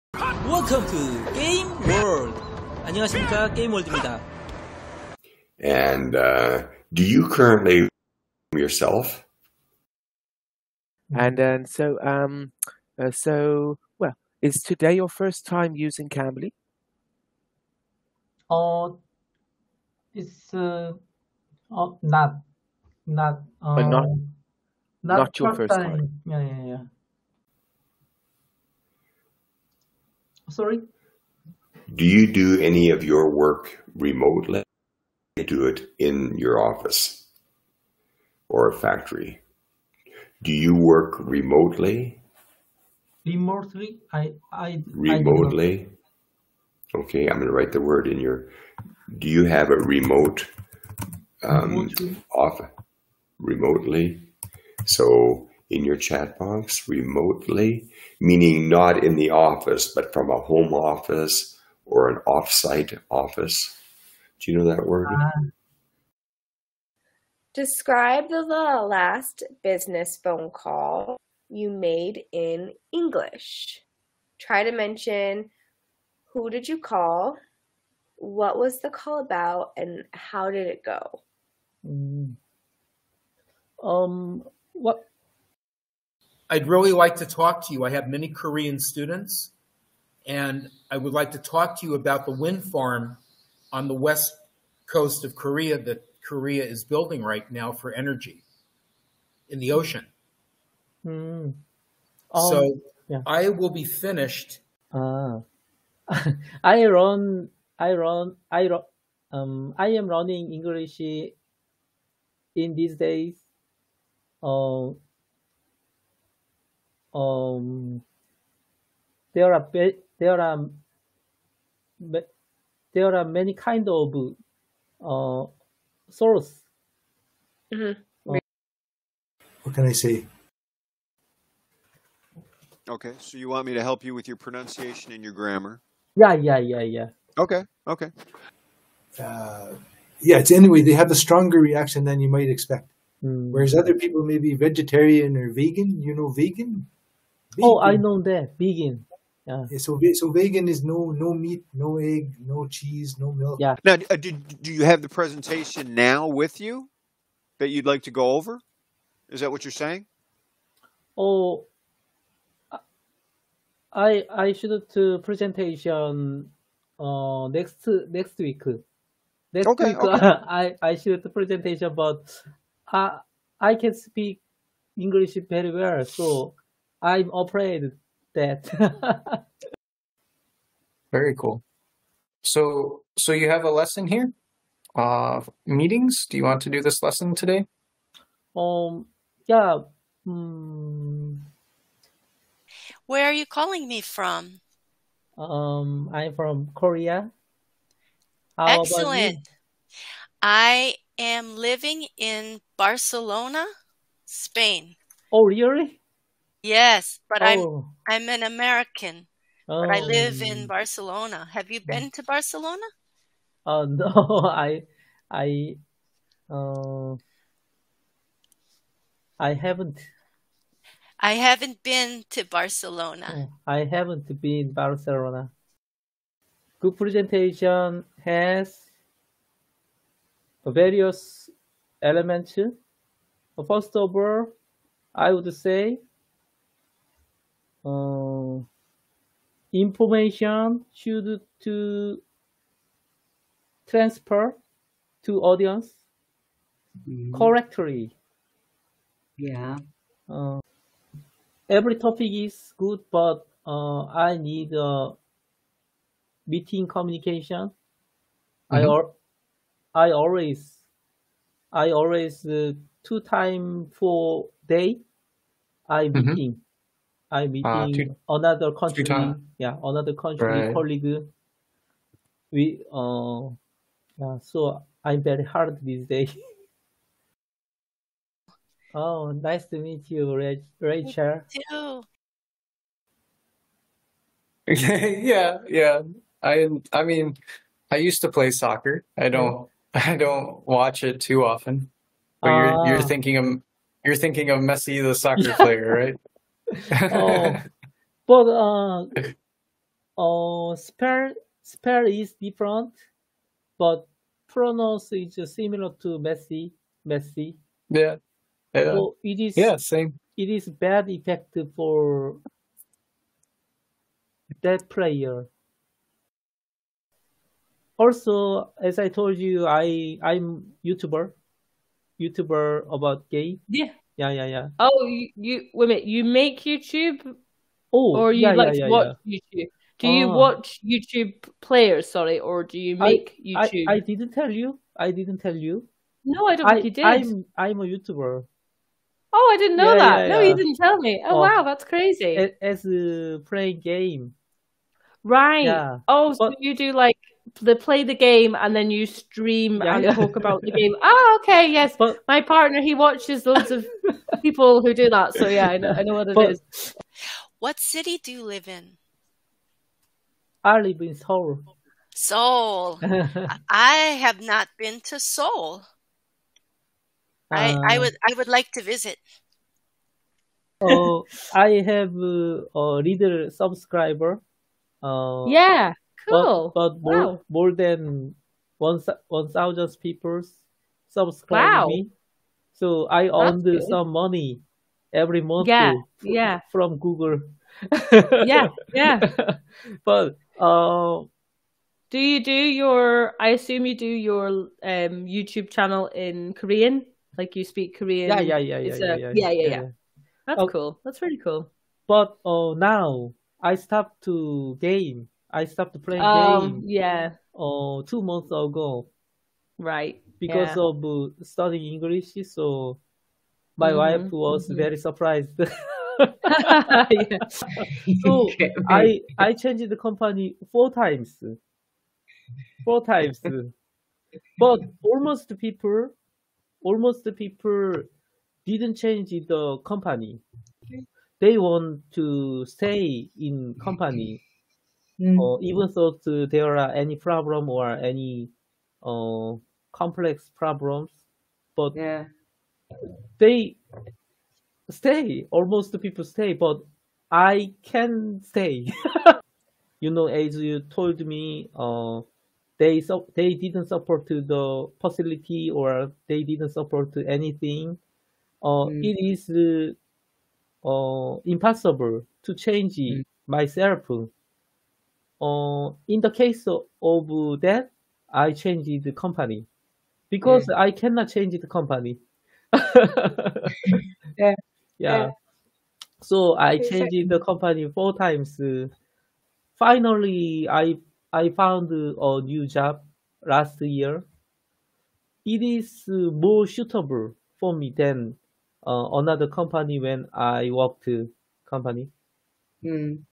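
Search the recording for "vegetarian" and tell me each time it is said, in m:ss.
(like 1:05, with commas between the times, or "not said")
2:24.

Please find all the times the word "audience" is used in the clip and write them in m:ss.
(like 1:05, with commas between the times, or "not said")
4:05.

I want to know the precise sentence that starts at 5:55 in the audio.
So yeah, I know, I know what it but, is.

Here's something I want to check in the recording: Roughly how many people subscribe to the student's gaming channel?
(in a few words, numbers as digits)
more than 1,000.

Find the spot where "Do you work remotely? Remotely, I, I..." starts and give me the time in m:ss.
0:40.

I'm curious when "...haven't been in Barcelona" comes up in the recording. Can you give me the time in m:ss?
3:43.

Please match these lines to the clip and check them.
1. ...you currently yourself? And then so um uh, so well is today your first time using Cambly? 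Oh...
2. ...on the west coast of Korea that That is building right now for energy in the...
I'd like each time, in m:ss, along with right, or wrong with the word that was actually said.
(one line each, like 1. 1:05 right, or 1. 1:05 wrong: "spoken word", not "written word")
1. 0:07 right
2. 1:33 wrong: "Korea", not "That".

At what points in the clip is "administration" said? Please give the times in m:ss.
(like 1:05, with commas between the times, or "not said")
not said.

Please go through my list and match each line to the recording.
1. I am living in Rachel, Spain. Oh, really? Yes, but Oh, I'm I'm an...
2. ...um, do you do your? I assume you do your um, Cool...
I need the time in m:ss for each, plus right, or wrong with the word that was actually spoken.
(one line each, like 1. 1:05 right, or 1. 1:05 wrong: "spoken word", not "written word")
1. 3:20 wrong: "Barcelona", not "Rachel"
2. 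6:30 wrong: "YouTube", not "Cool".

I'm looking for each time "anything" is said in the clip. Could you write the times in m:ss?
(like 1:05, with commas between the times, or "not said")
7:37.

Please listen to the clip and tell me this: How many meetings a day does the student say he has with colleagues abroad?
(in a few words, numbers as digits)
2.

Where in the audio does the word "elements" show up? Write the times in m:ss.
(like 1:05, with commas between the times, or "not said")
3:52.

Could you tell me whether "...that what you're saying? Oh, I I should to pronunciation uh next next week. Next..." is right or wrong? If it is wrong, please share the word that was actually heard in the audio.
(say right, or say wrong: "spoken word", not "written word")
wrong: "presentation", not "pronunciation".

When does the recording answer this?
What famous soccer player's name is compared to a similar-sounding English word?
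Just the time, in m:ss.
4:53.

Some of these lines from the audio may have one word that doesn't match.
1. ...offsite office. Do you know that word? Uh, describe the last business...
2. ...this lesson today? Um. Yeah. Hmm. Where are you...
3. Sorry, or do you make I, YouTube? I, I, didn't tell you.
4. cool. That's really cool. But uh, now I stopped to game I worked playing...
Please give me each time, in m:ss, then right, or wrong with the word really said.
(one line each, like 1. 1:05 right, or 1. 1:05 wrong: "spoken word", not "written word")
1. 1:02 right
2. 3:06 right
3. 5:32 right
4. 6:40 wrong: "stopped", not "worked".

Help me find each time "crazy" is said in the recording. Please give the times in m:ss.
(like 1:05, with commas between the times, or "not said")
5:41.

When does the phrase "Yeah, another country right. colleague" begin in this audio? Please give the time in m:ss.
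4:29.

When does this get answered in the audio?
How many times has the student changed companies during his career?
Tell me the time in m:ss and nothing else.
6:58.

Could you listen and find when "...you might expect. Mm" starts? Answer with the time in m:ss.
2:22.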